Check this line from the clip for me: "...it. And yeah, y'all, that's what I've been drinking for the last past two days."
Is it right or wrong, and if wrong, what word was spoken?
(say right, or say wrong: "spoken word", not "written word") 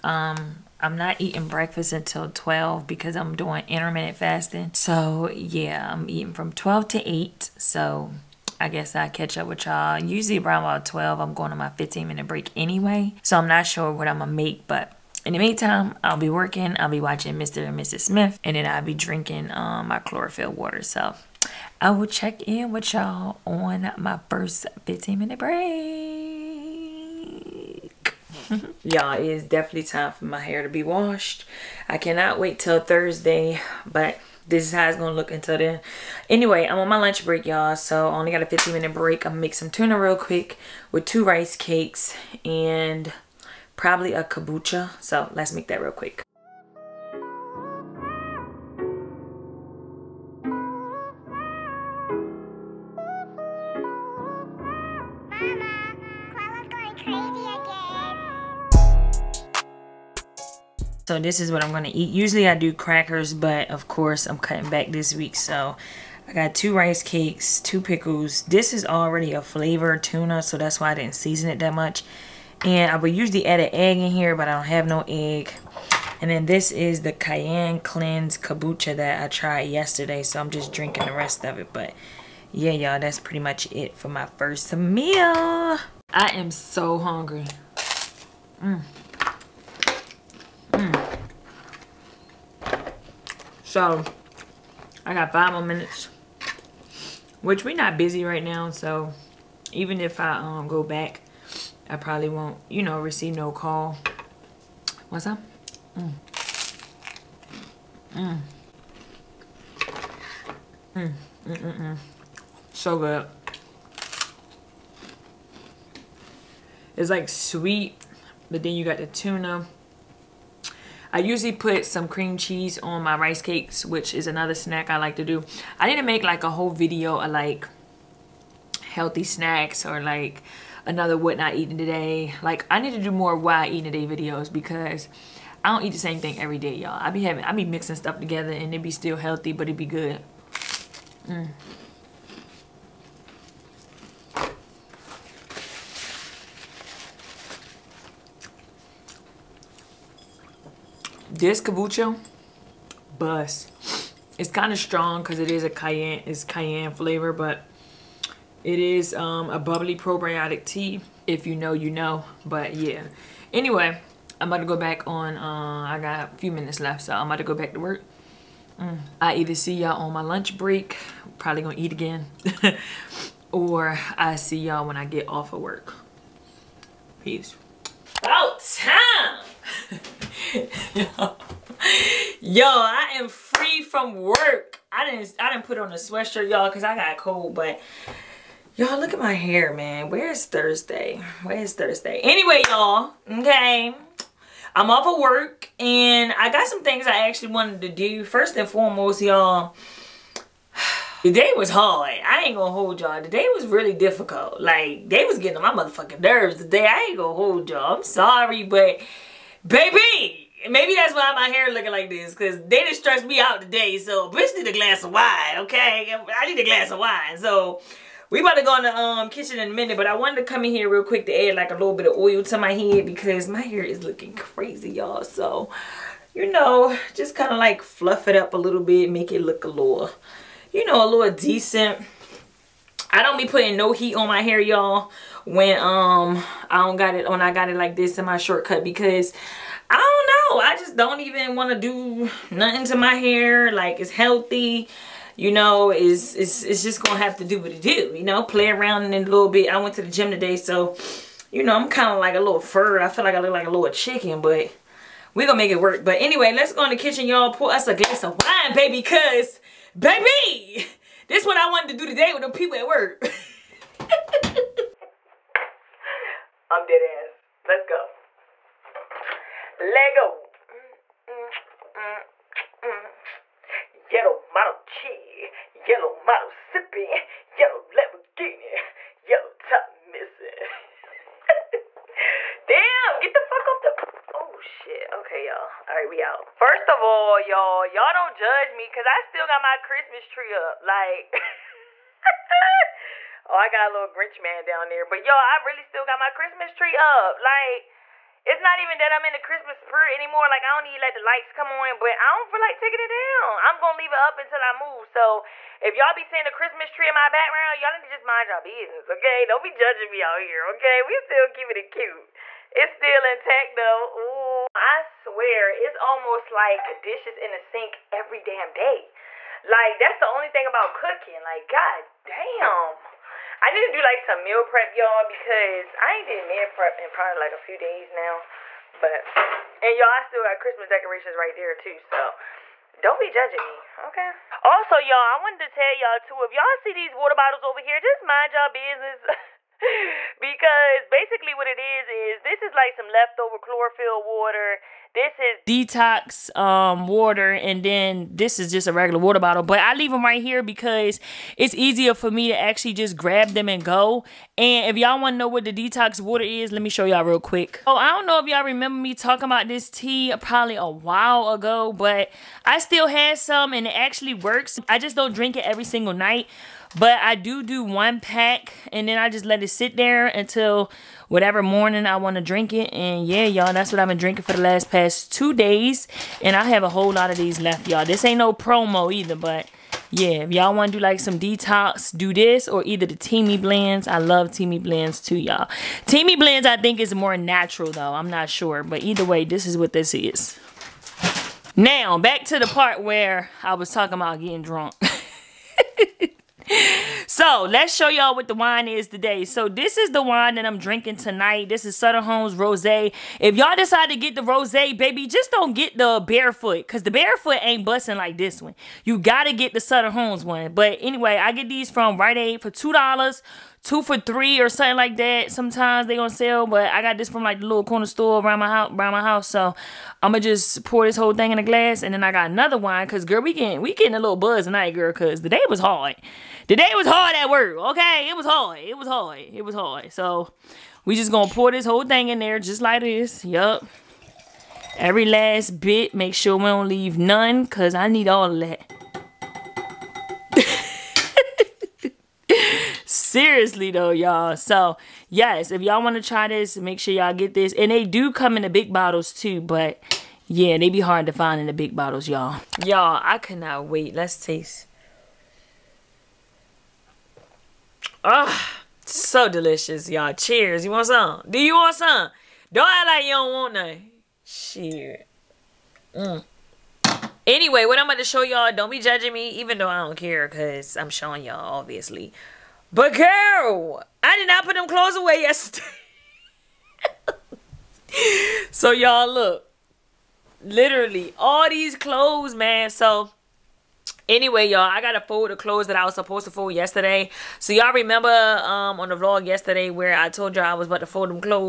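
right.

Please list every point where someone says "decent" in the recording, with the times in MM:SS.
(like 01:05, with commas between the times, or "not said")
03:51.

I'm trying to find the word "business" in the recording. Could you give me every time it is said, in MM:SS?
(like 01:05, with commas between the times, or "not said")
05:08, 05:38.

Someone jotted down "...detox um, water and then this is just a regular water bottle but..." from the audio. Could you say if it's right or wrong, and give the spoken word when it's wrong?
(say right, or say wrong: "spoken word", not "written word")
right.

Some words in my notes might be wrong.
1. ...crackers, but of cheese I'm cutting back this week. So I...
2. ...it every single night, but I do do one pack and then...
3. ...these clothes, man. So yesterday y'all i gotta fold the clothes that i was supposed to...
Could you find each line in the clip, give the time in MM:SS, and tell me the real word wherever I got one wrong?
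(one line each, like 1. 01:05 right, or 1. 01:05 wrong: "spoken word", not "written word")
1. 01:02 wrong: "course", not "cheese"
2. 06:05 right
3. 08:01 wrong: "anyway", not "yesterday".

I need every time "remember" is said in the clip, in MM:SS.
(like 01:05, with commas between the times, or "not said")
05:58, 08:07.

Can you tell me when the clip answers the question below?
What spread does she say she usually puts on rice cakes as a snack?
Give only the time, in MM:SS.
02:02.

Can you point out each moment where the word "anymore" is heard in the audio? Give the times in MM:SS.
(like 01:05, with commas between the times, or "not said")
05:00.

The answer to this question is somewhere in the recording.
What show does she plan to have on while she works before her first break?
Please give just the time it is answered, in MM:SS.
00:17.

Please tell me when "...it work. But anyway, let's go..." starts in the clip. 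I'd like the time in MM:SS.
04:15.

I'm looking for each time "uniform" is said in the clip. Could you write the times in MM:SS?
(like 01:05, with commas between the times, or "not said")
not said.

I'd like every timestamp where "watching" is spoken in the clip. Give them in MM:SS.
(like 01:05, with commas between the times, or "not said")
00:16.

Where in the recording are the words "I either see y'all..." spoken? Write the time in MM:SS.
02:49.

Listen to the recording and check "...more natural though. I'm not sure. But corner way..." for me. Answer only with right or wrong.
wrong.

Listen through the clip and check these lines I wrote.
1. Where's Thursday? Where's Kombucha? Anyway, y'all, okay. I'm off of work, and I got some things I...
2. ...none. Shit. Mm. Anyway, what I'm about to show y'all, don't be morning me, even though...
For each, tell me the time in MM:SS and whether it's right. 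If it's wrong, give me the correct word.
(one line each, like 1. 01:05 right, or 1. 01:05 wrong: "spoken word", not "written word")
1. 03:10 wrong: "Thursday", not "Kombucha"
2. 07:43 wrong: "judging", not "morning".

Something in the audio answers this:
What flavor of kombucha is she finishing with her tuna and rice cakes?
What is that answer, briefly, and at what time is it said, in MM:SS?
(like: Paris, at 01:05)
Cayenne Cleanse, at 01:17.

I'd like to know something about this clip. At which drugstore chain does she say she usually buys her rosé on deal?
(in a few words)
Rite Aid.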